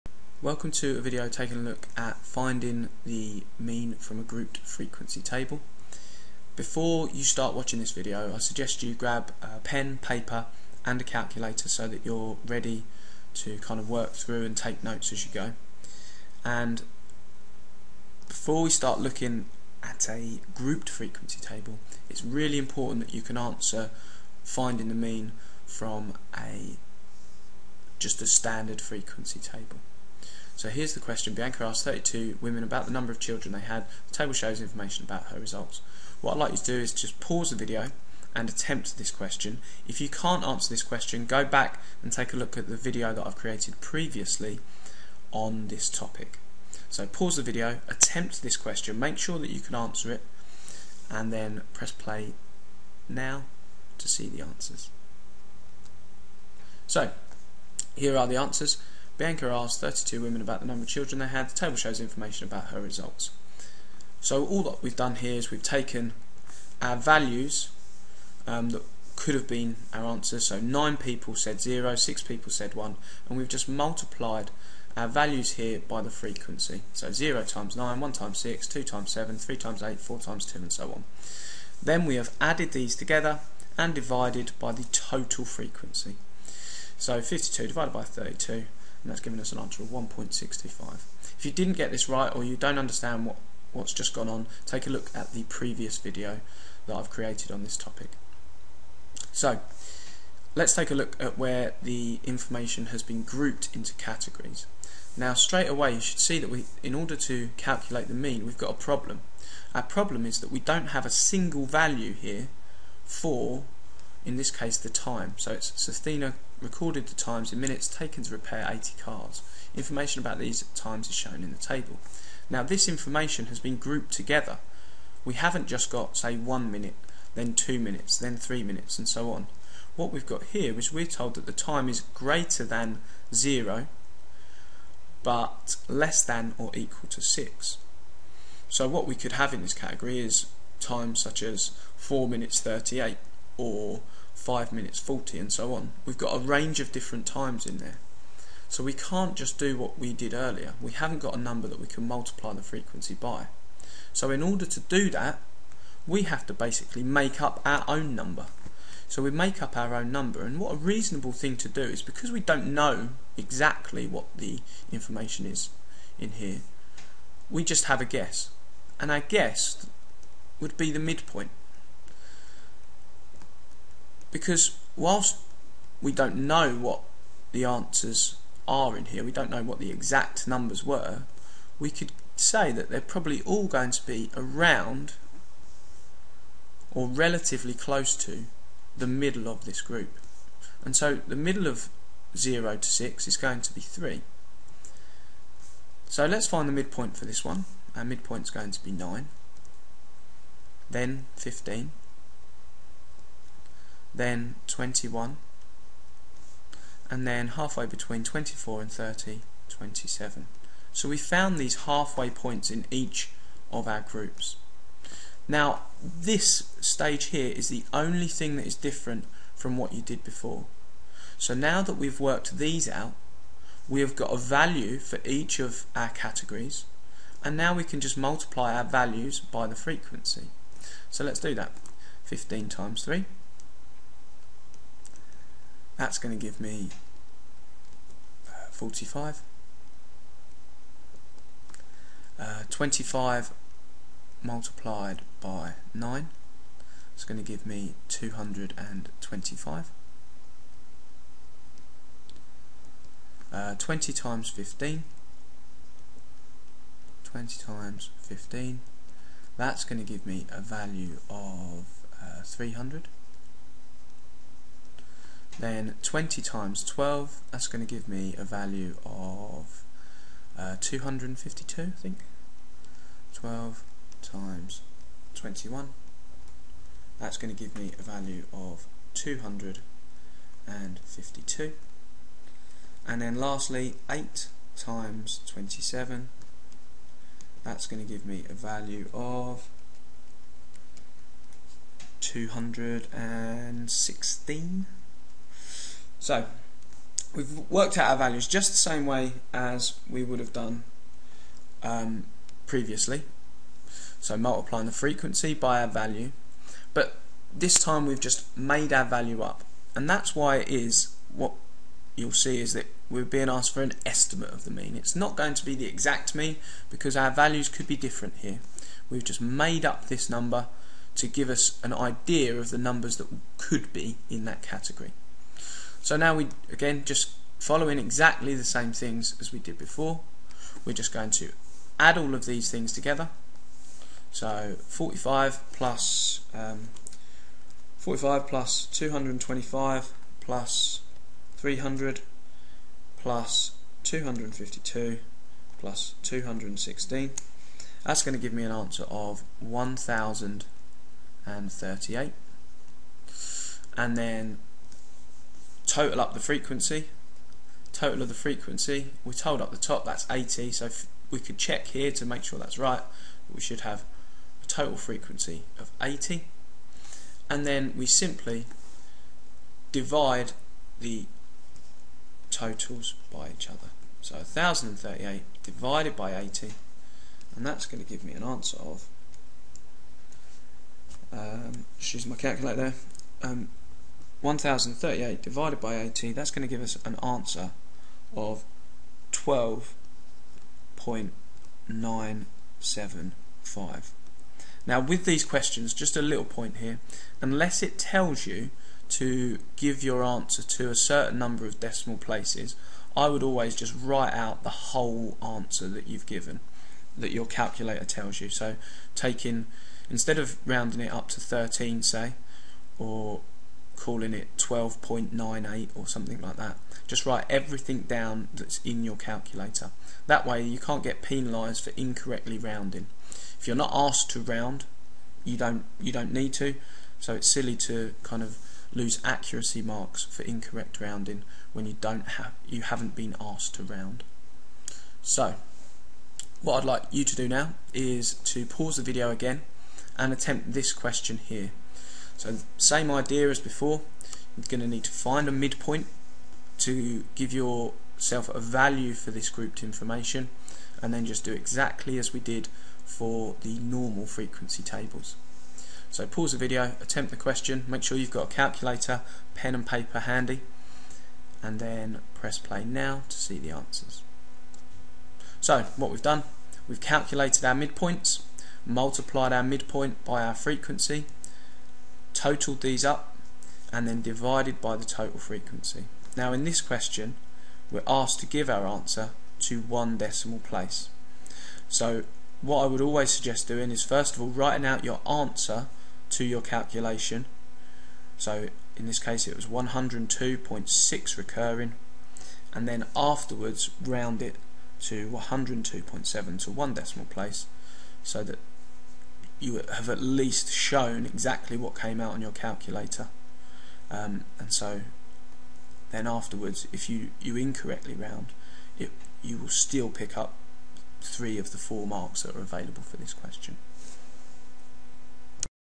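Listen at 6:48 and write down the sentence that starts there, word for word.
So taking, instead of rounding it up to 13 say, or calling it 12.98 or something like that.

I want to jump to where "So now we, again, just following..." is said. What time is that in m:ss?
5:26.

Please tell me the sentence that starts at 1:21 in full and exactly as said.
Then we have added these together and divided by the total frequency.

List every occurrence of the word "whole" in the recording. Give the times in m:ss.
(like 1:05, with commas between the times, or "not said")
6:44.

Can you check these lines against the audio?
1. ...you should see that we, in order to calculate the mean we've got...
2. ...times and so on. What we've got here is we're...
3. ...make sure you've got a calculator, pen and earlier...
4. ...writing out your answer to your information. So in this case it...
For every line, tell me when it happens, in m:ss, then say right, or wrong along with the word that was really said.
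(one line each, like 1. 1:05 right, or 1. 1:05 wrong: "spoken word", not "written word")
1. 1:45 right
2. 2:08 wrong: "minutes", not "times"
3. 7:37 wrong: "paper", not "earlier"
4. 8:04 wrong: "calculation", not "information".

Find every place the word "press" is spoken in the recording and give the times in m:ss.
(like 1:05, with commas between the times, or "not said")
0:51, 7:42.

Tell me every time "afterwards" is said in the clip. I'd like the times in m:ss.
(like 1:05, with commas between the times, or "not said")
8:13, 8:26.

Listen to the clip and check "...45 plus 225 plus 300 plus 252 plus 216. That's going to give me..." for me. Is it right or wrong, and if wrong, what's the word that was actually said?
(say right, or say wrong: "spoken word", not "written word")
right.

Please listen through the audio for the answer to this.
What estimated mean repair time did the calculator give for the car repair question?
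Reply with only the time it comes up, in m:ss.
6:29.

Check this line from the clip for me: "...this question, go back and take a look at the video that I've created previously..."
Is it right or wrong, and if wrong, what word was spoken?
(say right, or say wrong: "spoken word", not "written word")
right.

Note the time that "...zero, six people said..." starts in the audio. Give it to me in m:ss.
1:11.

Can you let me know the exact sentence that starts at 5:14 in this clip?
It's not going to be the exact mean because our values could be different here.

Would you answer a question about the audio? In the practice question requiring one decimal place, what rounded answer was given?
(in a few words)
102.7.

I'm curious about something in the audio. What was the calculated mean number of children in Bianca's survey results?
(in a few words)
1.65.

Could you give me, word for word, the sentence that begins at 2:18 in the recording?
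So what we could have in this category is times such as 4 minutes 38 or 5 minutes 40 and so on.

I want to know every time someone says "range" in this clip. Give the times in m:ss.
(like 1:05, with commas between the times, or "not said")
2:26.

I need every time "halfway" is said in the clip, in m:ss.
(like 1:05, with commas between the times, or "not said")
3:27, 3:31.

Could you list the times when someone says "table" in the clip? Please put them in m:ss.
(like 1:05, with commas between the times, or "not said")
0:05, 0:21, 0:29, 0:34, 1:01, 2:01, 7:34.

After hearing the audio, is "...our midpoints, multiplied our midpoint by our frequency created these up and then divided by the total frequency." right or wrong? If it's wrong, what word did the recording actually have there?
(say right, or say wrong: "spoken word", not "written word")
wrong: "totaled", not "created".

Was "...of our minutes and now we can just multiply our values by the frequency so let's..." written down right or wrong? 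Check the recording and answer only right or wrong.
wrong.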